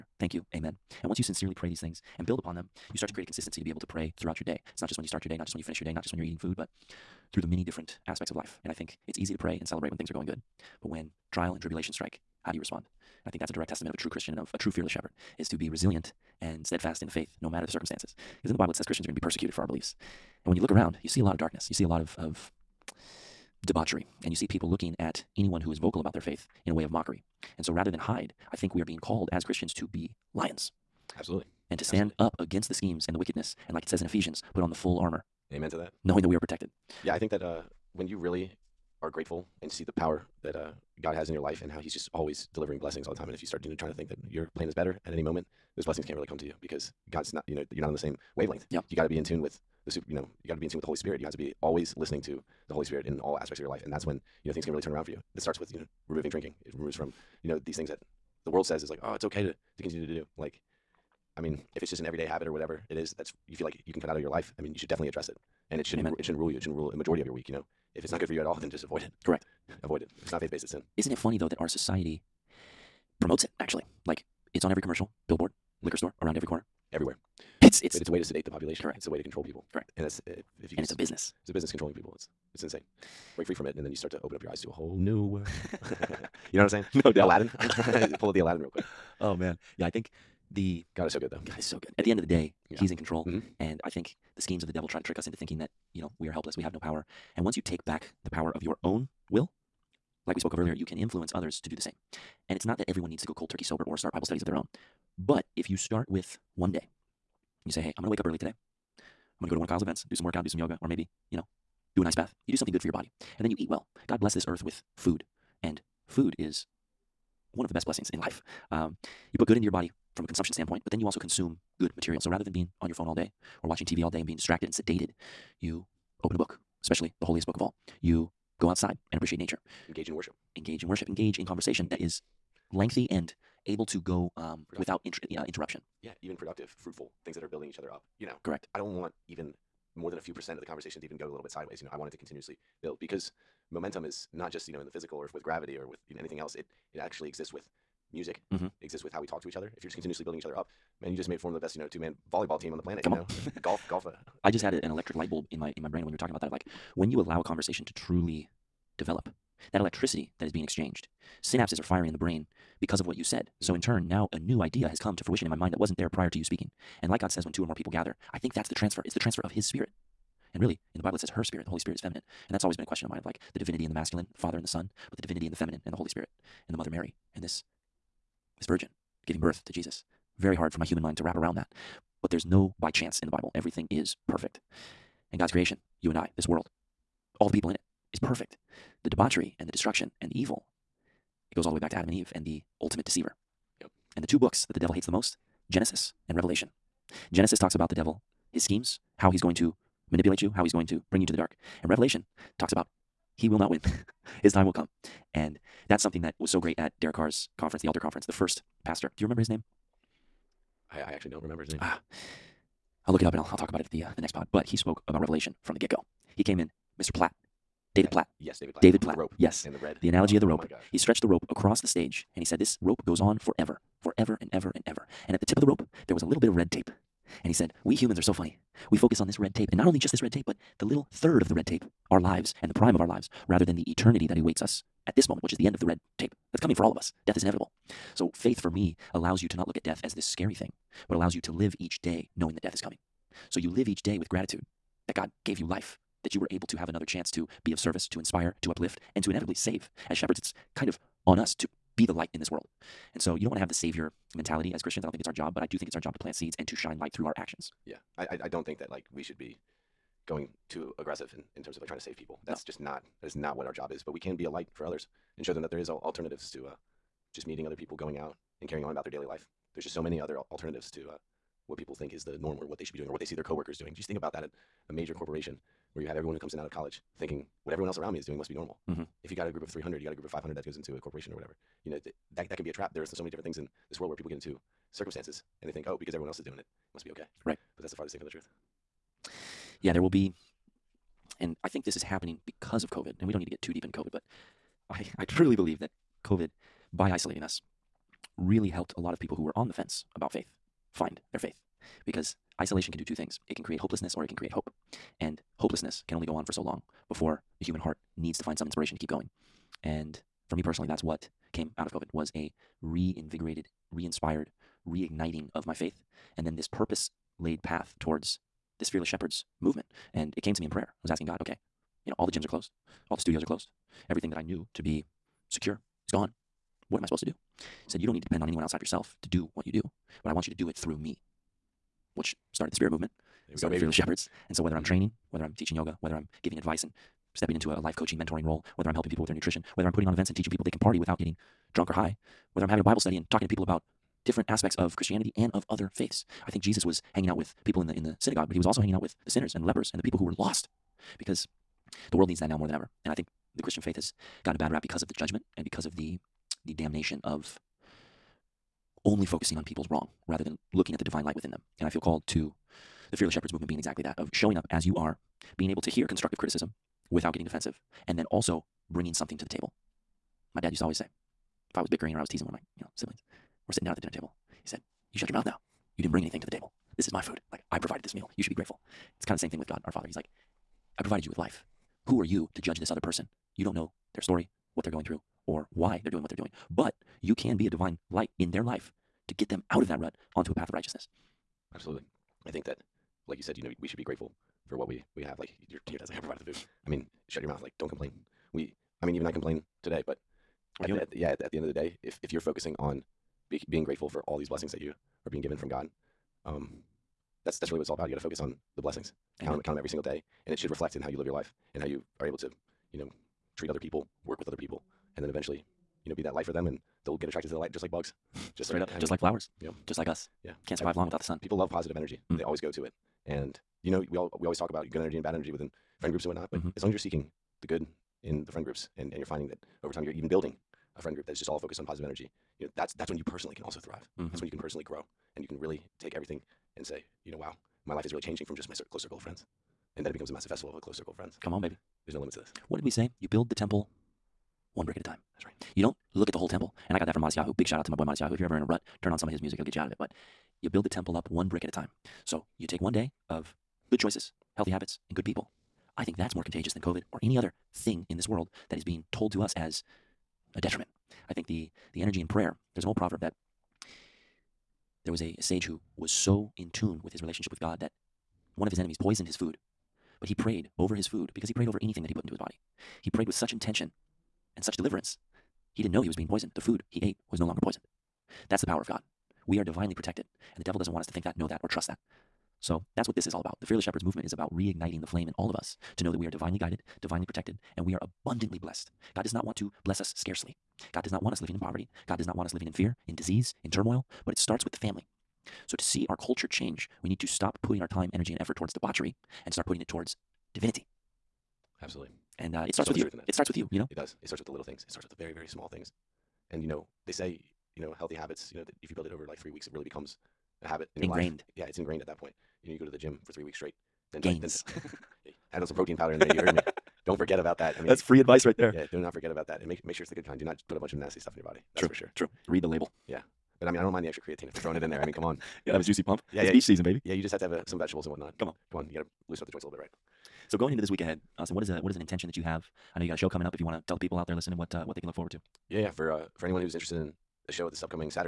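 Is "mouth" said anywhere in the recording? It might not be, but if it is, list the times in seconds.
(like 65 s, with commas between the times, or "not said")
375 s, 397 s.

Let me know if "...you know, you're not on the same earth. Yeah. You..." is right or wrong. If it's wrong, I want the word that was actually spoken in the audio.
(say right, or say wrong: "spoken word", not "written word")
wrong: "wavelength", not "earth".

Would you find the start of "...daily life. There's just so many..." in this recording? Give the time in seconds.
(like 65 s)
269 s.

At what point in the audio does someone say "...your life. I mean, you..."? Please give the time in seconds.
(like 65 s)
64 s.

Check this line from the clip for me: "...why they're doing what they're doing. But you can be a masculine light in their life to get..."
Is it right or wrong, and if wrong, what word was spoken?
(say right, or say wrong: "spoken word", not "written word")
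wrong: "divine", not "masculine".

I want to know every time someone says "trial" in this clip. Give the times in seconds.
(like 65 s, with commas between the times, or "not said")
11 s.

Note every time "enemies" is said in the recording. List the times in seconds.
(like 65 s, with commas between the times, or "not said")
468 s.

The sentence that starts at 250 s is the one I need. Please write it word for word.
As shepherds, it's kind of on us to be the light in this world.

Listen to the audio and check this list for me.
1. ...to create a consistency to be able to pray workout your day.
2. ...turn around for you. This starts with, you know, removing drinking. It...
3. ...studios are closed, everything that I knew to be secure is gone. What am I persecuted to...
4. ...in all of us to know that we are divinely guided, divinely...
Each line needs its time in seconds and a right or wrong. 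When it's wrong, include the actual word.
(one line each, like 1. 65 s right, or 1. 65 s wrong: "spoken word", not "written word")
1. 3 s wrong: "throughout", not "workout"
2. 54 s right
3. 323 s wrong: "supposed", not "persecuted"
4. 485 s right.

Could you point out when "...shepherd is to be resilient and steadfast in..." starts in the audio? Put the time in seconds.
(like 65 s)
14 s.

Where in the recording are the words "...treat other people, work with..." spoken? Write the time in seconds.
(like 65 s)
413 s.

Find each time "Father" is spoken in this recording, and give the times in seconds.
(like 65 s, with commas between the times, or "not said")
174 s, 379 s.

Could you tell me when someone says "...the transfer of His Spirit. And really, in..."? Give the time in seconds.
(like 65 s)
169 s.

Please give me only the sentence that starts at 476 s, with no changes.
The food he ate was no longer poisoned.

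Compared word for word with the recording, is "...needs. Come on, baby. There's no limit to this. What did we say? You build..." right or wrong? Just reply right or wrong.
wrong.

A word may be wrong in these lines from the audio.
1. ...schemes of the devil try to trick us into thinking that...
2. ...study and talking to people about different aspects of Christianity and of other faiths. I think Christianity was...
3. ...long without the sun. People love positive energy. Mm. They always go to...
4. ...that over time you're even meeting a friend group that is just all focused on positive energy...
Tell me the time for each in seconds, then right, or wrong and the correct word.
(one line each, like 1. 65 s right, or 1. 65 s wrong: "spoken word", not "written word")
1. 94 s right
2. 342 s wrong: "Jesus", not "Christianity"
3. 420 s right
4. 429 s wrong: "building", not "meeting".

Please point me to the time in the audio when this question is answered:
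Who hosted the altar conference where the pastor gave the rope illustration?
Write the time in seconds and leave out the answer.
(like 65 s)
207 s.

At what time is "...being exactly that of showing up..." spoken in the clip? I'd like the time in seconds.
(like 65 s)
363 s.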